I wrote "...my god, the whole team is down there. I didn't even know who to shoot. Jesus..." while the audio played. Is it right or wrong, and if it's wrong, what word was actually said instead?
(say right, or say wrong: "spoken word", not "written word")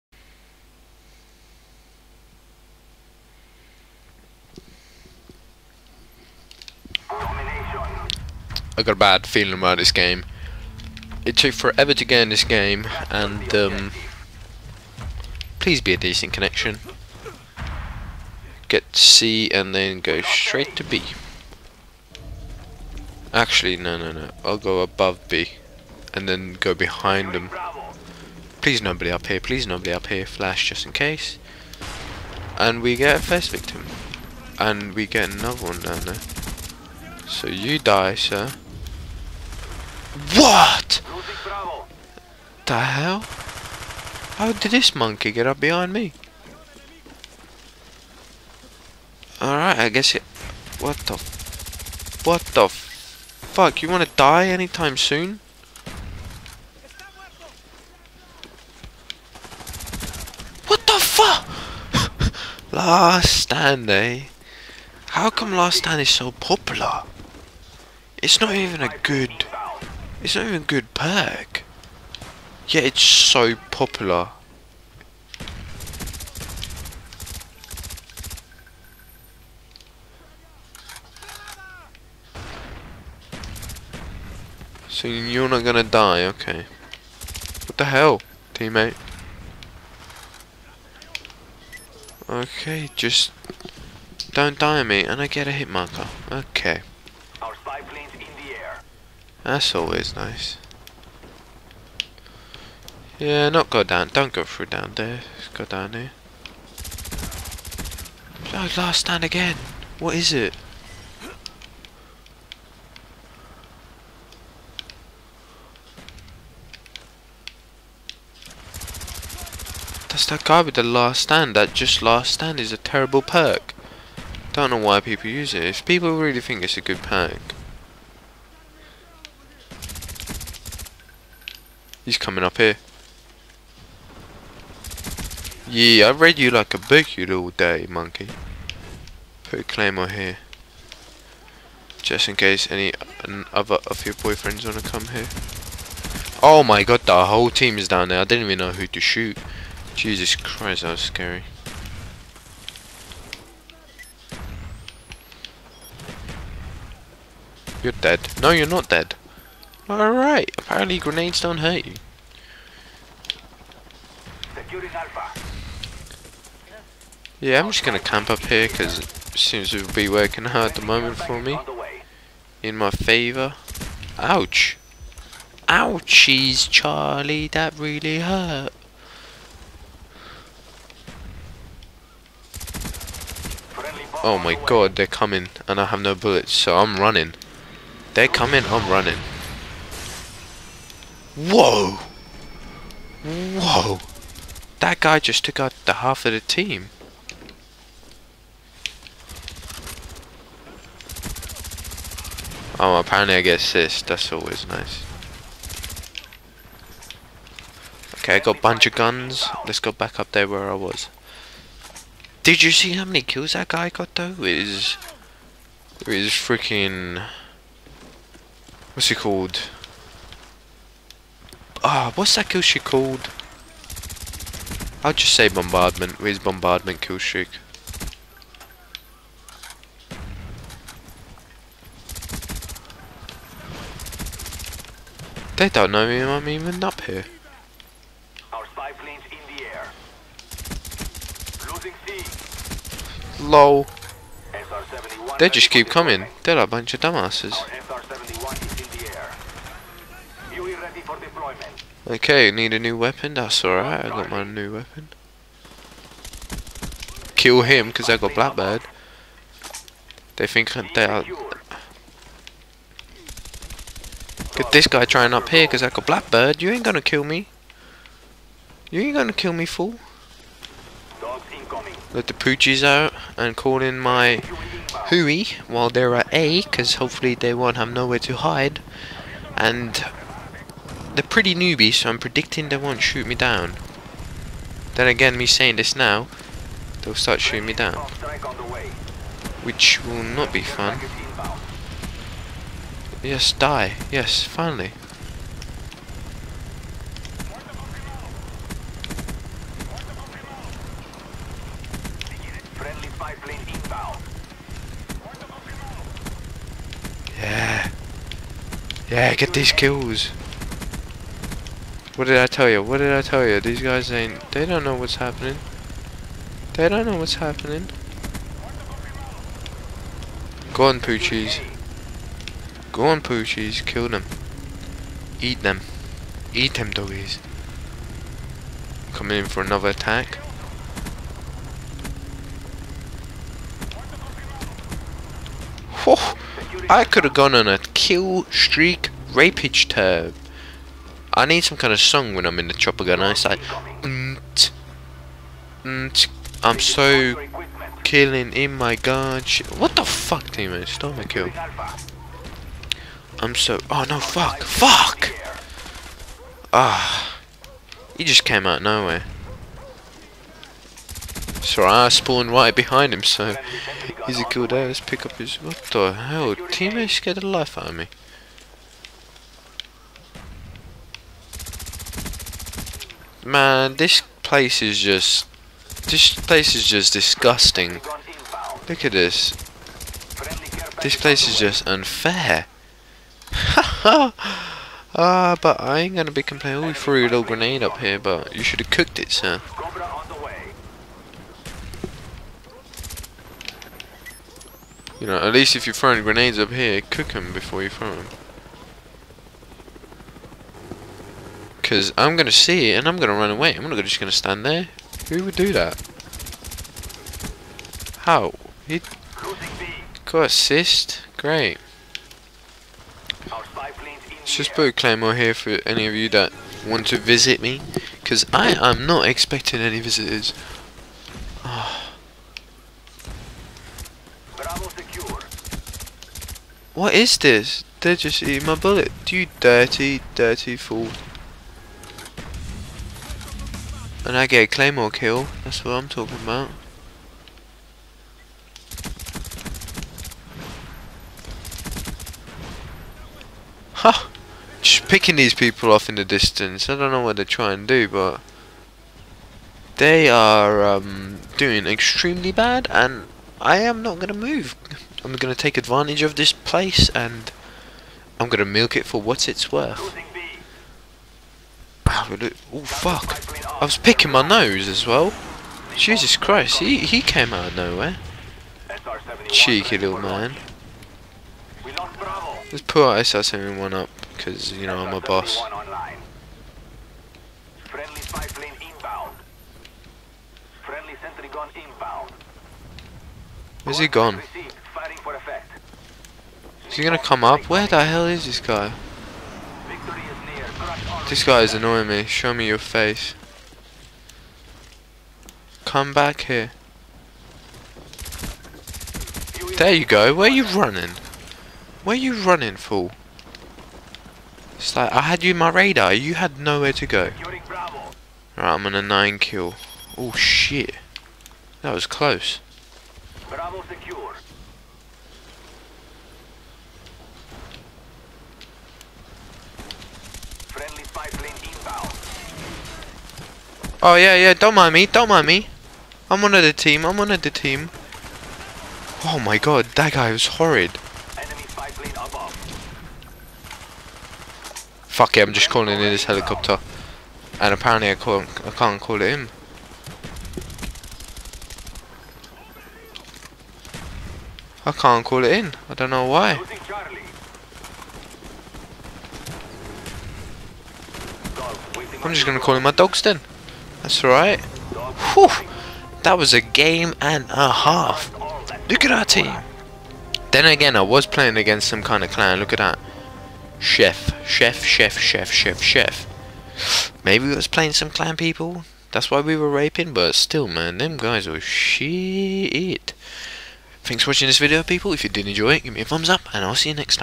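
right.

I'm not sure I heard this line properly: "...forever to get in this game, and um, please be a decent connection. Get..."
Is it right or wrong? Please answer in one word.
right.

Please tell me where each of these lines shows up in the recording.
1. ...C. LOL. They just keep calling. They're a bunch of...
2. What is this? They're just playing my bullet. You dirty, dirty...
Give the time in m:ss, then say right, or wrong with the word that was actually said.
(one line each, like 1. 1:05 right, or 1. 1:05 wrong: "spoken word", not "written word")
1. 4:02 wrong: "coming", not "calling"
2. 7:06 wrong: "eating", not "playing".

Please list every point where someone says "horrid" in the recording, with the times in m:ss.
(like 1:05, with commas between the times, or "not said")
8:50.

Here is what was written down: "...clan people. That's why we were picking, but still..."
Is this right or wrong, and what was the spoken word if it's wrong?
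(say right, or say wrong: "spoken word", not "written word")
wrong: "raping", not "picking".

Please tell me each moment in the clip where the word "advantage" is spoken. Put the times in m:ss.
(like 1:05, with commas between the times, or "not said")
7:35.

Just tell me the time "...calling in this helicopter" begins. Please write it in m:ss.
8:55.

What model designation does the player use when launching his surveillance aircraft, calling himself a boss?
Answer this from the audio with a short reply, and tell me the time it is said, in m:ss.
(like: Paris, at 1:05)
SR-71, at 7:53.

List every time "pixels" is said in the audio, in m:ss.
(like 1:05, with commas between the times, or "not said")
not said.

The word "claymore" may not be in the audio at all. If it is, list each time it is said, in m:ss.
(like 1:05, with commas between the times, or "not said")
2:19, 6:54, 7:14.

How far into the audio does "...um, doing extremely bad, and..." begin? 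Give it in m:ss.
7:30.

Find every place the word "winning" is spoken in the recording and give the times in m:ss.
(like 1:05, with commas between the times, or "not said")
not said.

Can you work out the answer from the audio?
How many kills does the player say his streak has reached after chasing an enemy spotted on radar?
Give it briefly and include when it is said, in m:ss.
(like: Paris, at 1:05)
9, at 8:28.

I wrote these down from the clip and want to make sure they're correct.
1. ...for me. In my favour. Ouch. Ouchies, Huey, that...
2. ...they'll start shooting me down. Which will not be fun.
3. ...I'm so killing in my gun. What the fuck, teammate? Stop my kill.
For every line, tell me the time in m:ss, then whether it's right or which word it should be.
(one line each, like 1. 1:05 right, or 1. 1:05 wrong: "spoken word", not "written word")
1. 2:51 wrong: "Charlie", not "Huey"
2. 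4:47 right
3. 5:45 right.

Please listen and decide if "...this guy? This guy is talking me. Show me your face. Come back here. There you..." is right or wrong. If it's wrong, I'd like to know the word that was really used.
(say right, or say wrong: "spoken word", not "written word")
wrong: "annoying", not "talking".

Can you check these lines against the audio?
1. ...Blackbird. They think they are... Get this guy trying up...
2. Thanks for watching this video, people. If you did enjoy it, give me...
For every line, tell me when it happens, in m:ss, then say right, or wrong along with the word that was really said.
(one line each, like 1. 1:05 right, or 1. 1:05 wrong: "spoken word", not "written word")
1. 4:18 right
2. 9:34 right.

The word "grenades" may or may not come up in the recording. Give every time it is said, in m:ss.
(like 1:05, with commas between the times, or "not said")
2:40, 6:27, 6:36.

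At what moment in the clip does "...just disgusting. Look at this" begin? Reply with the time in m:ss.
6:16.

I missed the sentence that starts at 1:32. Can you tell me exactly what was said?
Okay, just don't die on me and I get a hit marker.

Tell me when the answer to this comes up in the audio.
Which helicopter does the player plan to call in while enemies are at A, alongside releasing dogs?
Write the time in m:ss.
4:33.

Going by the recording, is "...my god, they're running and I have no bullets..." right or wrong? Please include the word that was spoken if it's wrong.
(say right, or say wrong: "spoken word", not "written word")
wrong: "coming", not "running".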